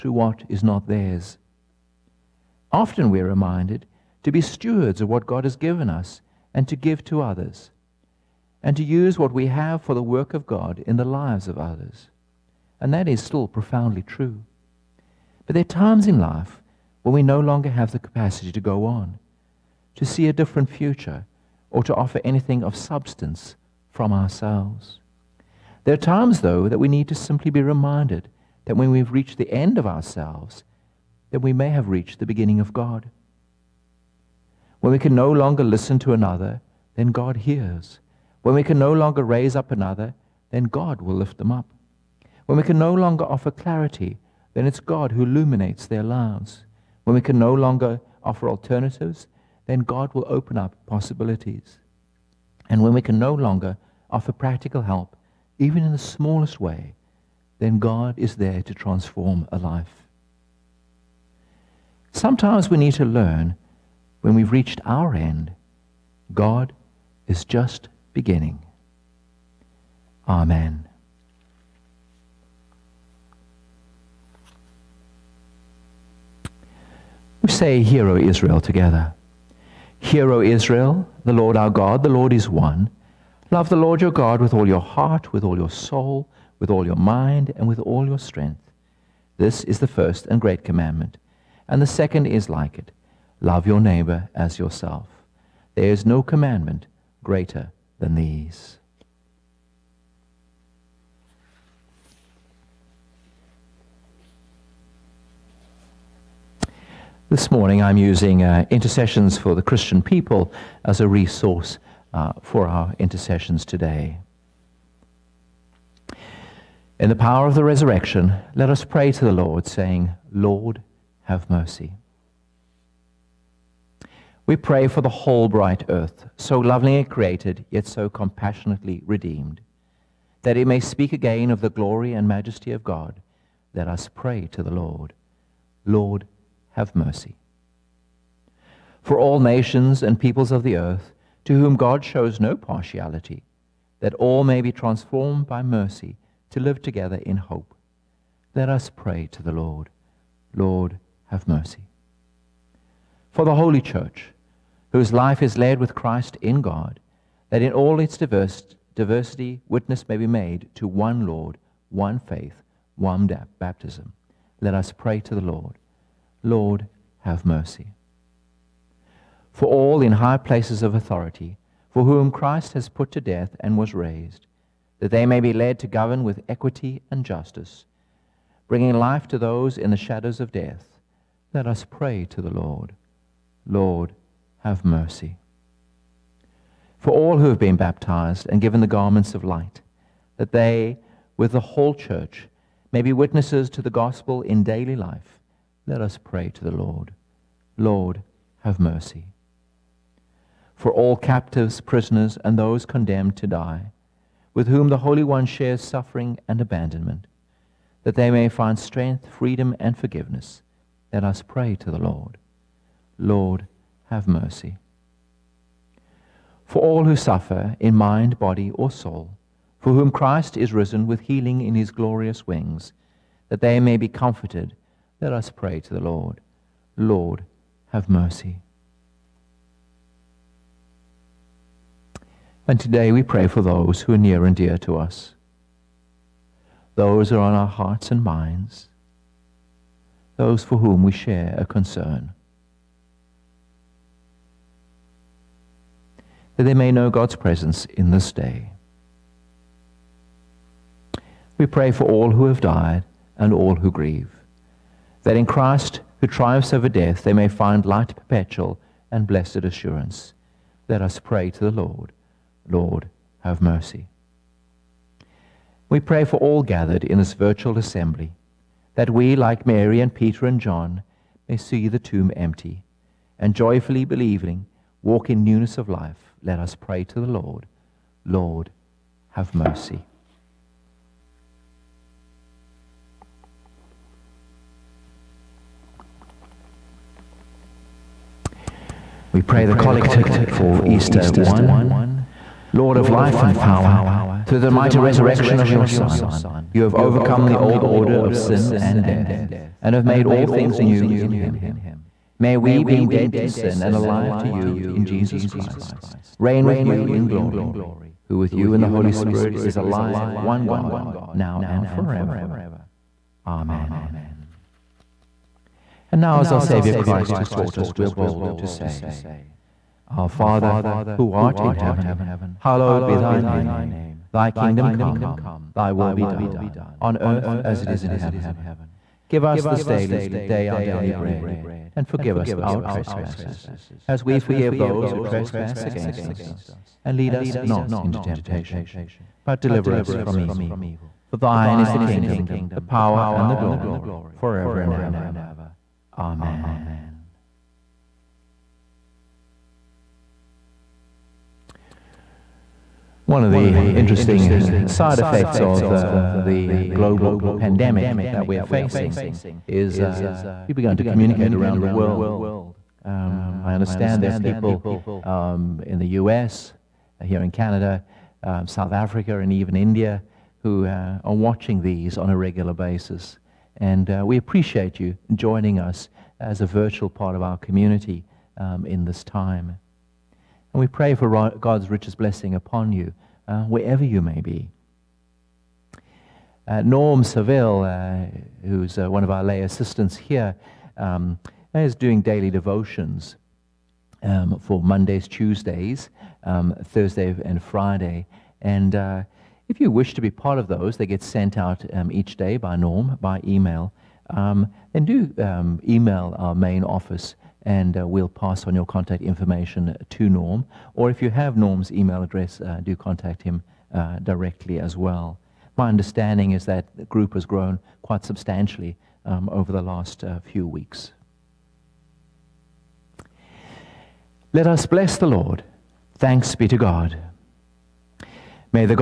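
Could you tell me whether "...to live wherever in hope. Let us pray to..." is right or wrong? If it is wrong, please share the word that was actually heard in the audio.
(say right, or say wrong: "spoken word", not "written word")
wrong: "together", not "wherever".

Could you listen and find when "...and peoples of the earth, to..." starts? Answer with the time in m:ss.
2:20.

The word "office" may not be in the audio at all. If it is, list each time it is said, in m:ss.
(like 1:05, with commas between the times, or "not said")
6:46.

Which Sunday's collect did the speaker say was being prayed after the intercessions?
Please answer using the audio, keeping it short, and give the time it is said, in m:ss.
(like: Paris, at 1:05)
Easter 1, at 4:50.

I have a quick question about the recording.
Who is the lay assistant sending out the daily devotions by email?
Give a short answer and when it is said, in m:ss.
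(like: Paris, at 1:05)
Norm Saville, at 6:26.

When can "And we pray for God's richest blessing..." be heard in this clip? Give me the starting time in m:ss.
6:20.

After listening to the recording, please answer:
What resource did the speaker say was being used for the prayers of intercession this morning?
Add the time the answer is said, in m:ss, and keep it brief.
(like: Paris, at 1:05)
Intercessions for the Christian People, at 1:48.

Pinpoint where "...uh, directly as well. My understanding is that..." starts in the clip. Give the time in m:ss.
6:53.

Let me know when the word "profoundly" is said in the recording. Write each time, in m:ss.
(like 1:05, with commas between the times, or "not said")
0:13.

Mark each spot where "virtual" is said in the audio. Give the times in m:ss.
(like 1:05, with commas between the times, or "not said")
4:27, 6:16.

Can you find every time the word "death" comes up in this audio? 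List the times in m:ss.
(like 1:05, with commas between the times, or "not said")
2:53, 3:00, 4:16, 4:59.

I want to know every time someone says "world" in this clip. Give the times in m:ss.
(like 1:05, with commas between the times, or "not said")
6:01.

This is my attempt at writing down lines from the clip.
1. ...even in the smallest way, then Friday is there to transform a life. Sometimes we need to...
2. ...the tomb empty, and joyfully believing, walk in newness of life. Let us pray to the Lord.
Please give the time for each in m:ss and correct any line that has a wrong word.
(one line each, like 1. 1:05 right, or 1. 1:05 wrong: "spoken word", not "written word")
1. 0:55 wrong: "God", not "Friday"
2. 4:31 right.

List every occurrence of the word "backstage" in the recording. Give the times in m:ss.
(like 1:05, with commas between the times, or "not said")
not said.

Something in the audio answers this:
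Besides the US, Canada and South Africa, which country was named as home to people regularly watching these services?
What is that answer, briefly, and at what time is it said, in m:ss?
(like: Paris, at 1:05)
India, at 6:09.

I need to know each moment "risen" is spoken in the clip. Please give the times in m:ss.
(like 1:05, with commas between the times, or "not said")
3:40.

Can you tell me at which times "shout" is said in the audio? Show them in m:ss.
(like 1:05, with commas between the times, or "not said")
not said.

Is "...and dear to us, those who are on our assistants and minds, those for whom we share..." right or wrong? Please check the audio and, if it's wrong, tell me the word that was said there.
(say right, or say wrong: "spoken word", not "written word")
wrong: "hearts", not "assistants".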